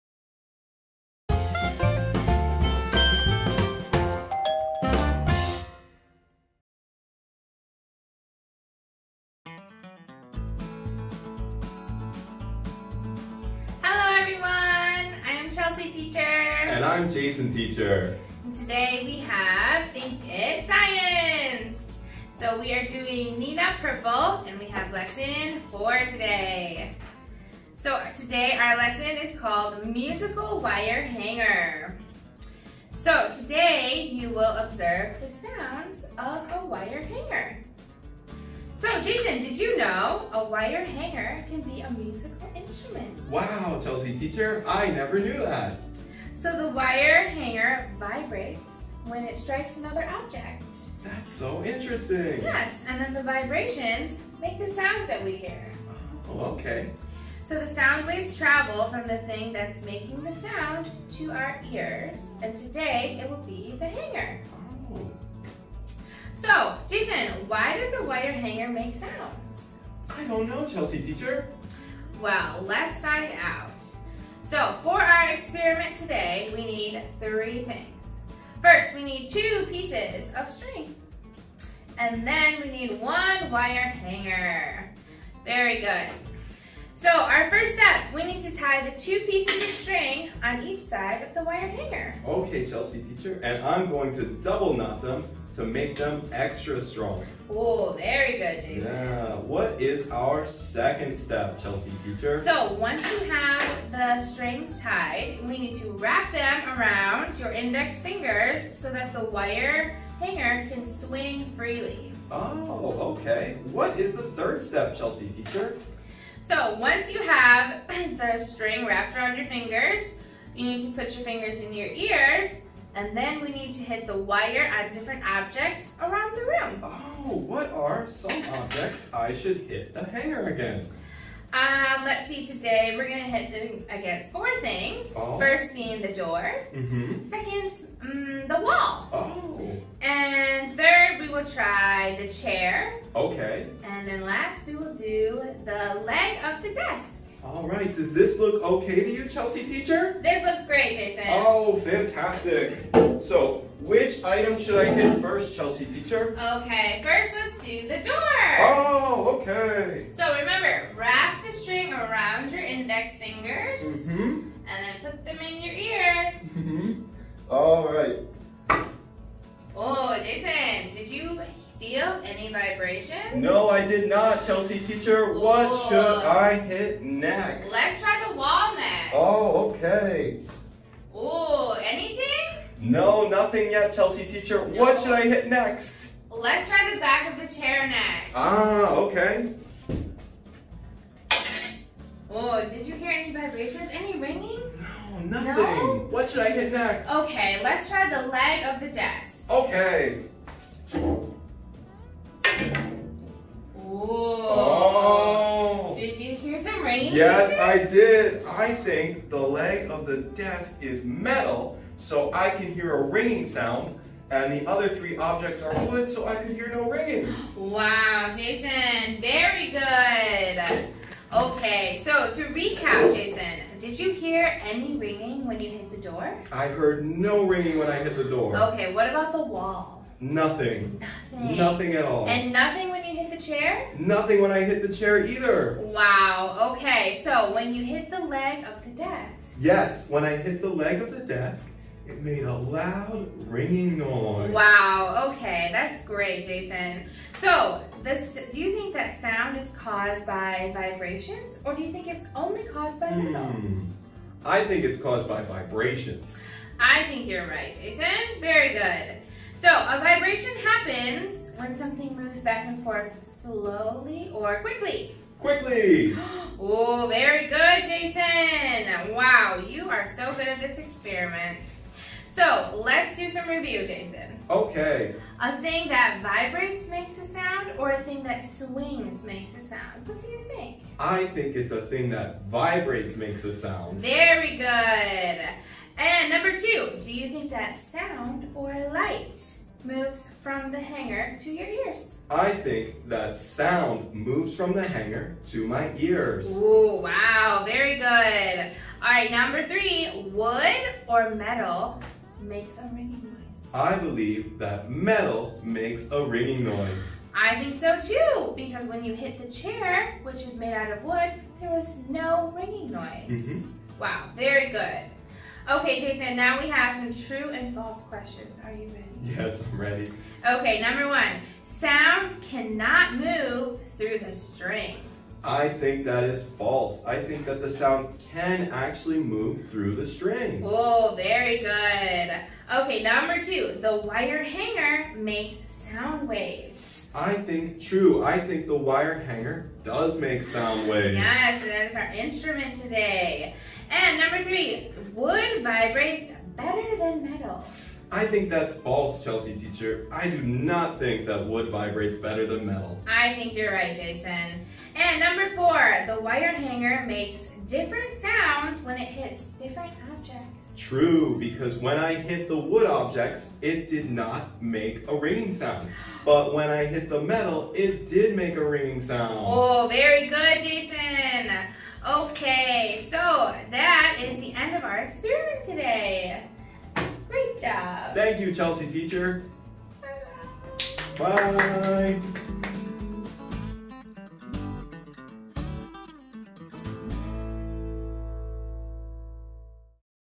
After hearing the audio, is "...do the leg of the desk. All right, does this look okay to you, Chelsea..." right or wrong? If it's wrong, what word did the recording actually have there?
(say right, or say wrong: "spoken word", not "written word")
right.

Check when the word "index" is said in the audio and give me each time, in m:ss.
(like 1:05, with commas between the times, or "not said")
1:47, 2:42.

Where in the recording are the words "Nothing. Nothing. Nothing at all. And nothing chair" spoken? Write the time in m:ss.
3:50.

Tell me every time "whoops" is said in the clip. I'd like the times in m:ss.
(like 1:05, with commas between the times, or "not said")
not said.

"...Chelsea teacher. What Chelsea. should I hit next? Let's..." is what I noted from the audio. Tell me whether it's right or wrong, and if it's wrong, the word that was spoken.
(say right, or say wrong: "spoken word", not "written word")
wrong: "Ooh", not "Chelsea".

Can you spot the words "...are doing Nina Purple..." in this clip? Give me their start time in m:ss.
0:22.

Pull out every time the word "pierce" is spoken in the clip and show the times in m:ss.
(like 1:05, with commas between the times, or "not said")
not said.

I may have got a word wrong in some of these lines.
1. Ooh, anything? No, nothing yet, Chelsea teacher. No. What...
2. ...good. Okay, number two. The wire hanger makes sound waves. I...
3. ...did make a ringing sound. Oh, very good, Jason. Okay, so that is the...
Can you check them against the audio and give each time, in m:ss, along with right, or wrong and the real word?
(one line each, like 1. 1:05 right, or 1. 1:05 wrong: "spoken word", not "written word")
1. 3:01 right
2. 5:31 right
3. 6:08 right.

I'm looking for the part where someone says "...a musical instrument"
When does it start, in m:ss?
0:41.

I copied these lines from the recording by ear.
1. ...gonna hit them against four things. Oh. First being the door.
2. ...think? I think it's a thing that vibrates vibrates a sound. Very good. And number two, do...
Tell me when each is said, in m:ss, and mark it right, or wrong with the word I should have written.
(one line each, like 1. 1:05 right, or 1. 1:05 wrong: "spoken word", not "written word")
1. 2:13 right
2. 4:40 wrong: "makes", not "vibrates".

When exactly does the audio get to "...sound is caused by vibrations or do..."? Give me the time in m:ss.
4:09.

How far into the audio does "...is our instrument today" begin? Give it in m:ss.
5:41.